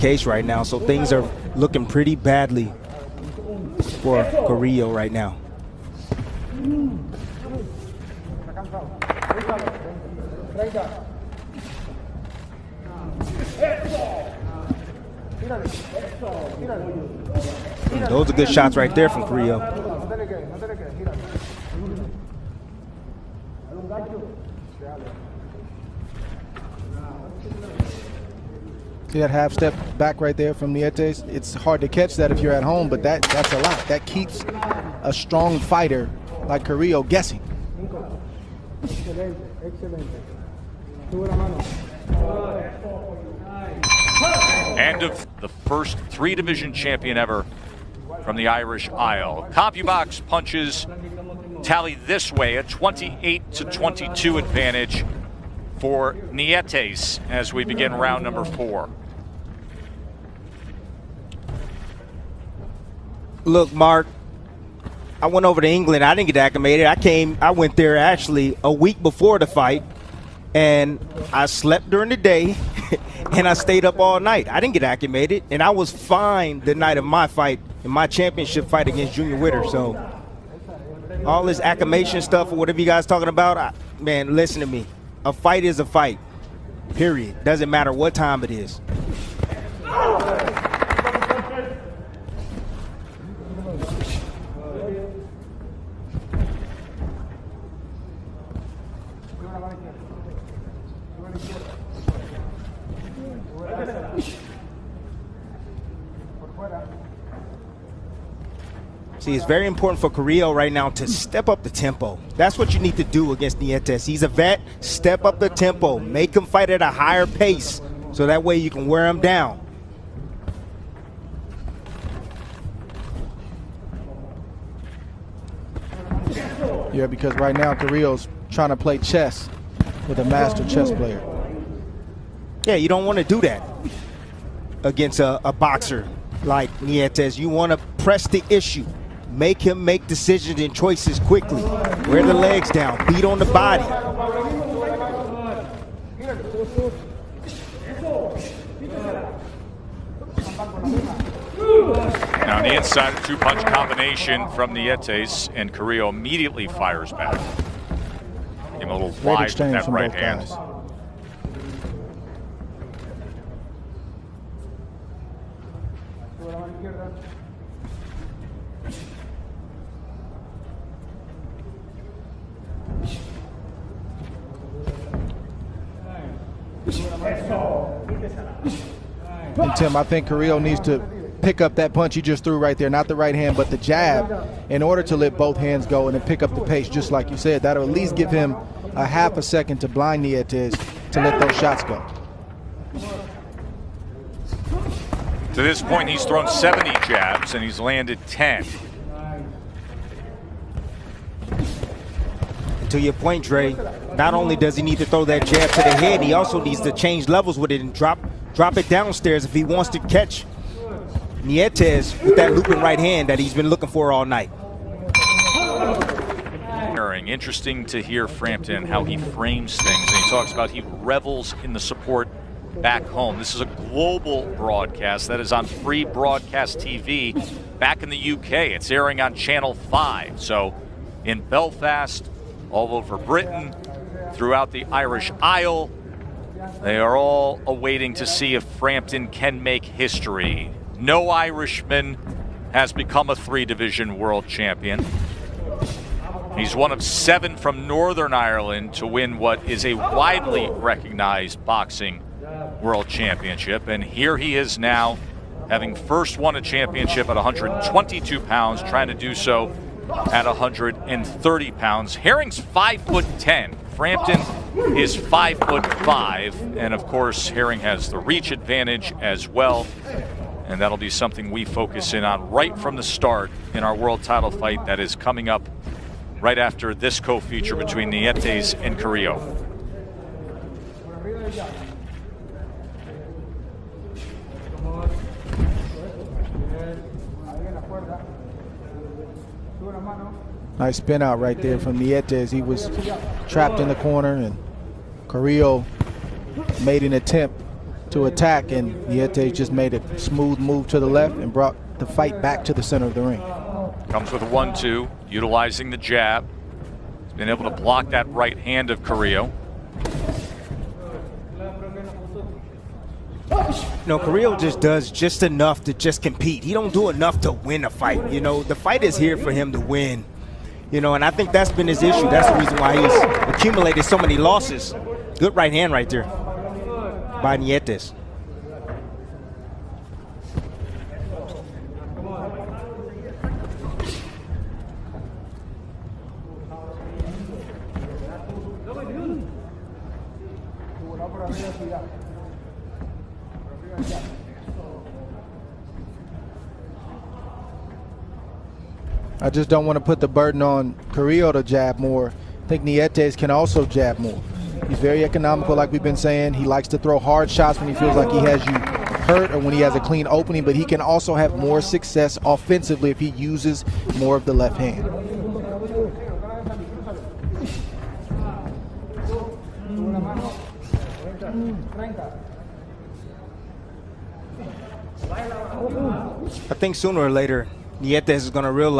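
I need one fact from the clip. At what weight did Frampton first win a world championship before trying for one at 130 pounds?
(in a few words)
122 pounds.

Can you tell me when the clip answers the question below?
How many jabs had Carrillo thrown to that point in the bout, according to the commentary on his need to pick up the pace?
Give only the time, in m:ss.
3:16.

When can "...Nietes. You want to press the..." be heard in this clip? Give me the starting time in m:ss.
2:16.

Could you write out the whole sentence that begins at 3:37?
Interesting to hear Frampton, how he frames things.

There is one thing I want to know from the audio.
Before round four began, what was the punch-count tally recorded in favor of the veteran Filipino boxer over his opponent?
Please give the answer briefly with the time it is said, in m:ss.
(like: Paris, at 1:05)
28 to 22, at 0:52.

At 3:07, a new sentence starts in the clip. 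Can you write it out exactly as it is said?
That'll at least give him a half a second to blind Nietes to let those shots go.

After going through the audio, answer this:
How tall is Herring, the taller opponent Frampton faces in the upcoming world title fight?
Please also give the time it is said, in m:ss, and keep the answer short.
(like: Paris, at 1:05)
5 foot 10, at 4:22.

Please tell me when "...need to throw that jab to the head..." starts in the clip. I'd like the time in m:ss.
3:24.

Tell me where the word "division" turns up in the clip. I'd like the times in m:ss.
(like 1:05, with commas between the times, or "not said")
0:46, 4:03.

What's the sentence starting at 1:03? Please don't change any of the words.
Look, Mark, I went over to England.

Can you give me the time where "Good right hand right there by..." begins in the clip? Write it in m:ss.
5:25.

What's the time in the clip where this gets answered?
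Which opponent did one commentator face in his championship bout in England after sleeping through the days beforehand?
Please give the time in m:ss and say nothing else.
1:19.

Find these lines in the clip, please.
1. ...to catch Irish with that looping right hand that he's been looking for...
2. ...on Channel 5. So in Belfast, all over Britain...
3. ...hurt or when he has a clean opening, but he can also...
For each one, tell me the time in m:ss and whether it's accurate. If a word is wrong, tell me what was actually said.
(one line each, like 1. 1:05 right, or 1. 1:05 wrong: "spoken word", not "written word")
1. 3:29 wrong: "Nietes", not "Irish"
2. 3:49 right
3. 5:59 right.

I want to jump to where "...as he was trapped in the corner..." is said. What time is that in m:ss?
4:52.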